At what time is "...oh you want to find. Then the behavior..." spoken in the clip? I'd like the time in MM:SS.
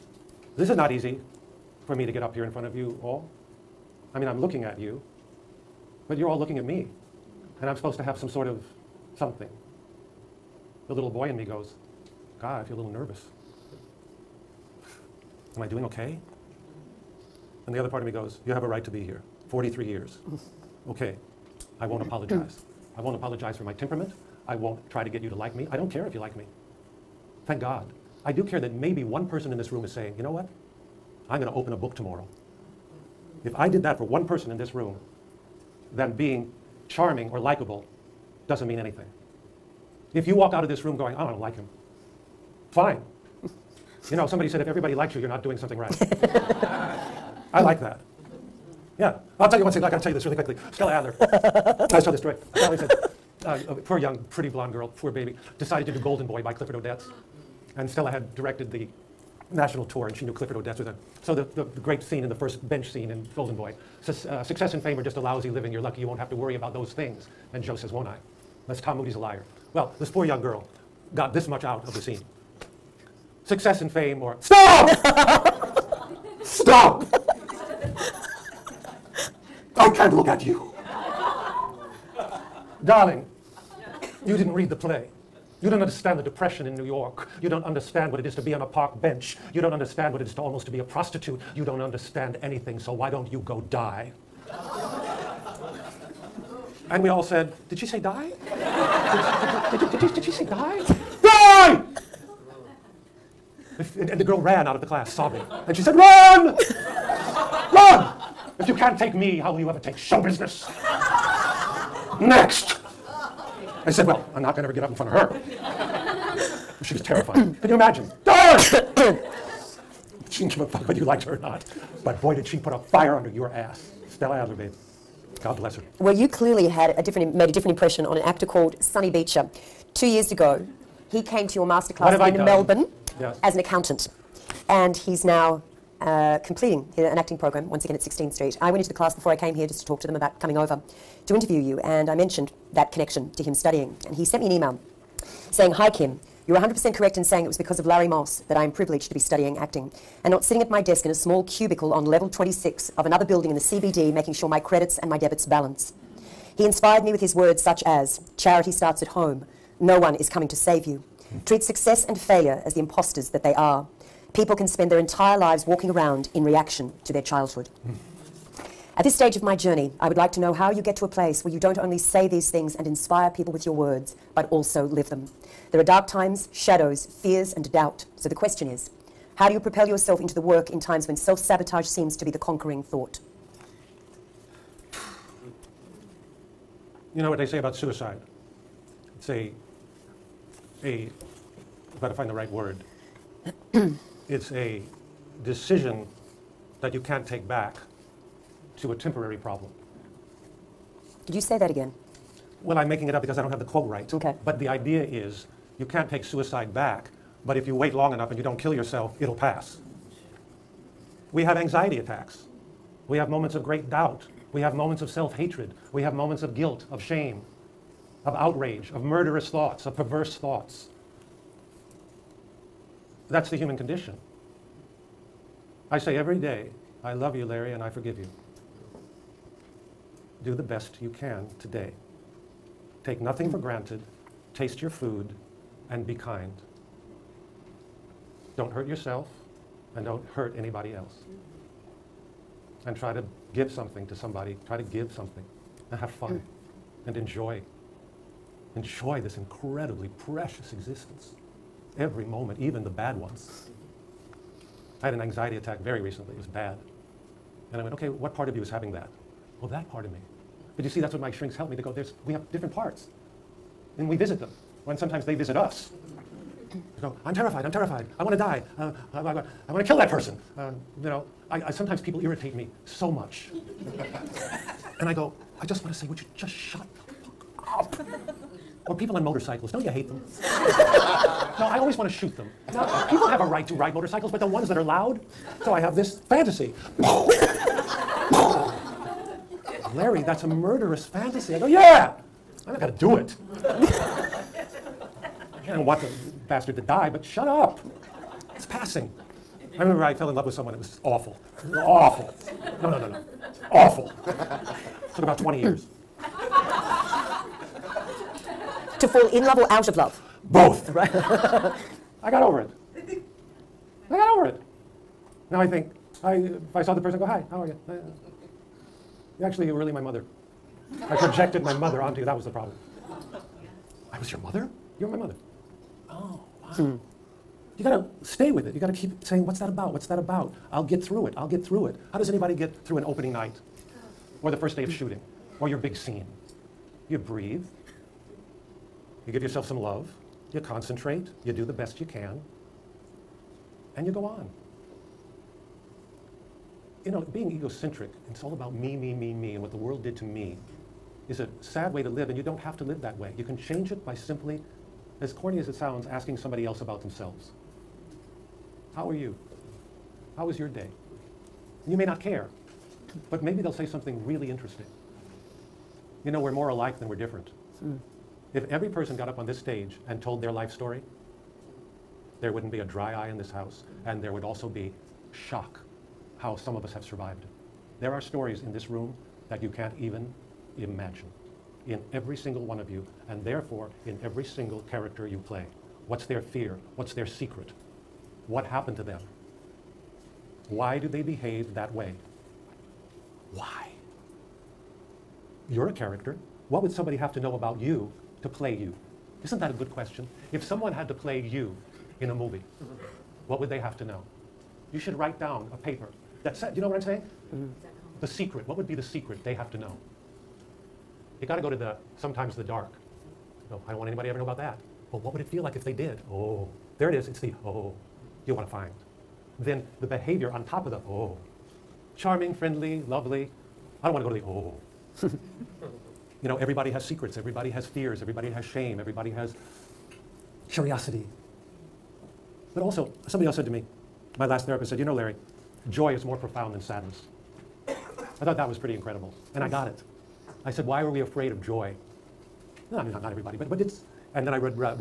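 06:57.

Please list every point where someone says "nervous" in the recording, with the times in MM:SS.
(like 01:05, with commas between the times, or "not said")
00:12.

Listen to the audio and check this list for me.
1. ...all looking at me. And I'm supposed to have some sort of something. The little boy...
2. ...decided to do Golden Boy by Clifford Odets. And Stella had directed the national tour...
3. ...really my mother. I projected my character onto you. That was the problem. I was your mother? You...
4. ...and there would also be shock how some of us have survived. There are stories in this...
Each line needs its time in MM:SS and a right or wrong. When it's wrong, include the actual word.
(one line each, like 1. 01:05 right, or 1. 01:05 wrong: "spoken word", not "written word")
1. 00:06 right
2. 00:55 right
3. 05:19 wrong: "mother", not "character"
4. 06:14 right.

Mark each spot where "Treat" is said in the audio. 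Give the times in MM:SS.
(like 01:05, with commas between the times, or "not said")
02:41.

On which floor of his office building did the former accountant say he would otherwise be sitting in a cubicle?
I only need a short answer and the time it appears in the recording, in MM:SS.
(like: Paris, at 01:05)
26, at 02:32.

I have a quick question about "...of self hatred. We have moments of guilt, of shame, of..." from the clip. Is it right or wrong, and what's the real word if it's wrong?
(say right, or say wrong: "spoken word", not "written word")
right.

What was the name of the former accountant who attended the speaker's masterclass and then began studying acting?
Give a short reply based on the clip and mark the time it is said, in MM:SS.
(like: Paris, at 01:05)
Sonny Beecher, at 02:08.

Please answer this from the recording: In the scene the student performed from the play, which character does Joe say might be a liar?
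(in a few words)
Tom Moody.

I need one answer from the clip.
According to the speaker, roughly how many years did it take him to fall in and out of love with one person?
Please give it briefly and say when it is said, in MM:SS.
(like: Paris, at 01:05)
20, at 05:05.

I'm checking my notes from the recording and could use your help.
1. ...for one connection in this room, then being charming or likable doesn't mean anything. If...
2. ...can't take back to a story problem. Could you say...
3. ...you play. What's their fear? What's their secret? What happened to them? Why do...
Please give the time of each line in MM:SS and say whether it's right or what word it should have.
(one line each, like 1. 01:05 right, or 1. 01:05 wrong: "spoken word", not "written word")
1. 00:33 wrong: "person", not "connection"
2. 03:17 wrong: "temporary", not "story"
3. 06:25 right.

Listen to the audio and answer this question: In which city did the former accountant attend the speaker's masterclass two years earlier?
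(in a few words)
Melbourne.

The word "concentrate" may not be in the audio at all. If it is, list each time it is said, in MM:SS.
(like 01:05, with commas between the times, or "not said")
05:40.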